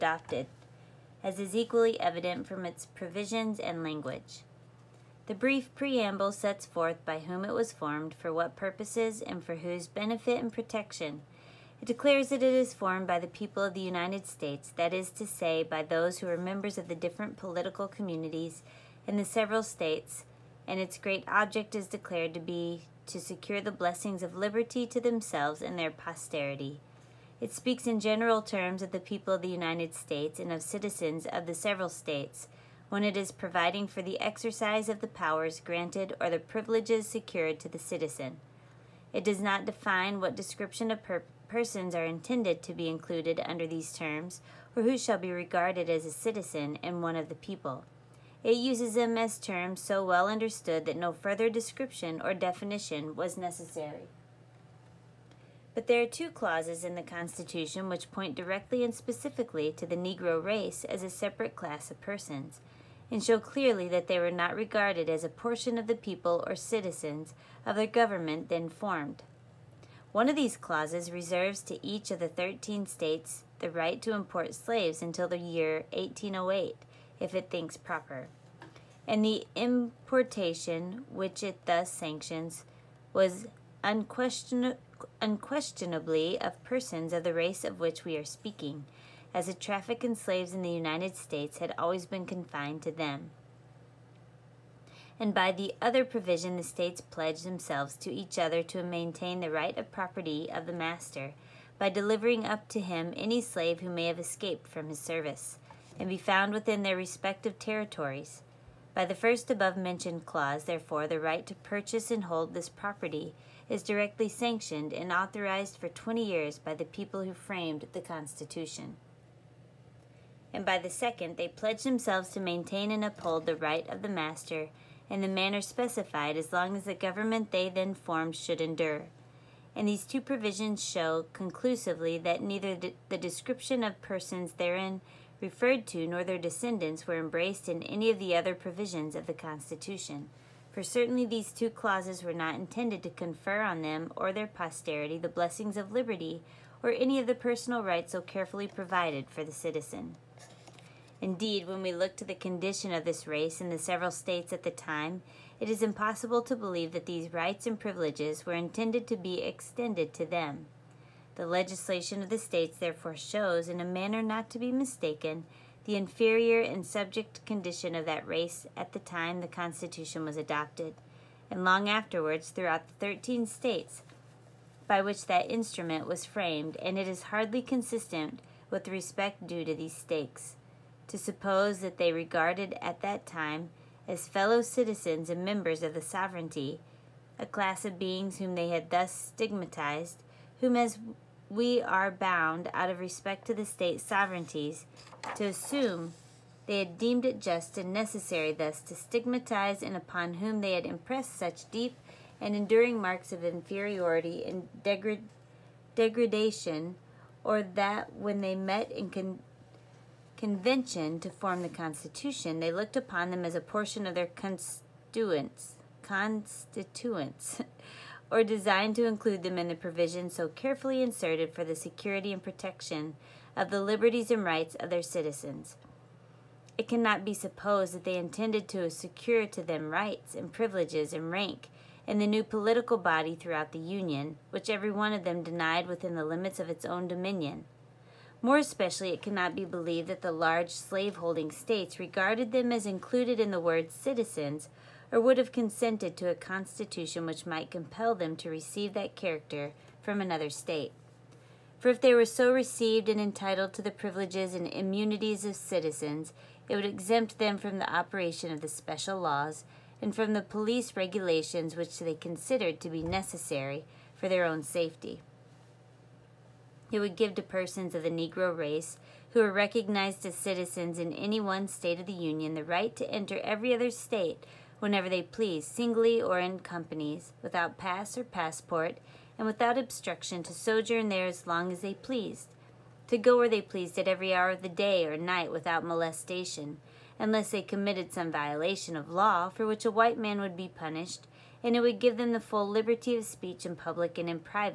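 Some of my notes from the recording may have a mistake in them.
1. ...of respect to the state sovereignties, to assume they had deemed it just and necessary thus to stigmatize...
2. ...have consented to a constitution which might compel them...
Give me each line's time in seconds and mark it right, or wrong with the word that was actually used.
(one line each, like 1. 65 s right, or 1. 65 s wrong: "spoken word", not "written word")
1. 192 s right
2. 245 s right.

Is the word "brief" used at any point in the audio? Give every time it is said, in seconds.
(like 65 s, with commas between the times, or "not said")
5 s.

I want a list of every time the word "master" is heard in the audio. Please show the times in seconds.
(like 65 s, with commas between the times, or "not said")
100 s, 124 s.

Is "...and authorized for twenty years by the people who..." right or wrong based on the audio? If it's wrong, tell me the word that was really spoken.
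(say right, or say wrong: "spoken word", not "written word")
right.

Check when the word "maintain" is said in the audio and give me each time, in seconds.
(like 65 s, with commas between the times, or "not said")
98 s, 122 s.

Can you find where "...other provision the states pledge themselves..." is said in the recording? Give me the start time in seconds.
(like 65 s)
95 s.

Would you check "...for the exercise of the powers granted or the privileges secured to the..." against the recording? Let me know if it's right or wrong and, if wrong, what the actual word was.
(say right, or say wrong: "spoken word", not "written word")
right.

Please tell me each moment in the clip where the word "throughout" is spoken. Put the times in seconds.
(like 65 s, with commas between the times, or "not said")
172 s, 233 s.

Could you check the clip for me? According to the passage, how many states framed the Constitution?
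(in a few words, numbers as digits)
13.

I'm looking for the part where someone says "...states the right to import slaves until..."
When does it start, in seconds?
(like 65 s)
72 s.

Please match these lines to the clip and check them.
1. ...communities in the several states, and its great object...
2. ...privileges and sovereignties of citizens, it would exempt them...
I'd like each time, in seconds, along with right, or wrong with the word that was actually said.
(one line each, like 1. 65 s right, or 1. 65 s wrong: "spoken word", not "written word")
1. 17 s right
2. 253 s wrong: "immunities", not "sovereignties".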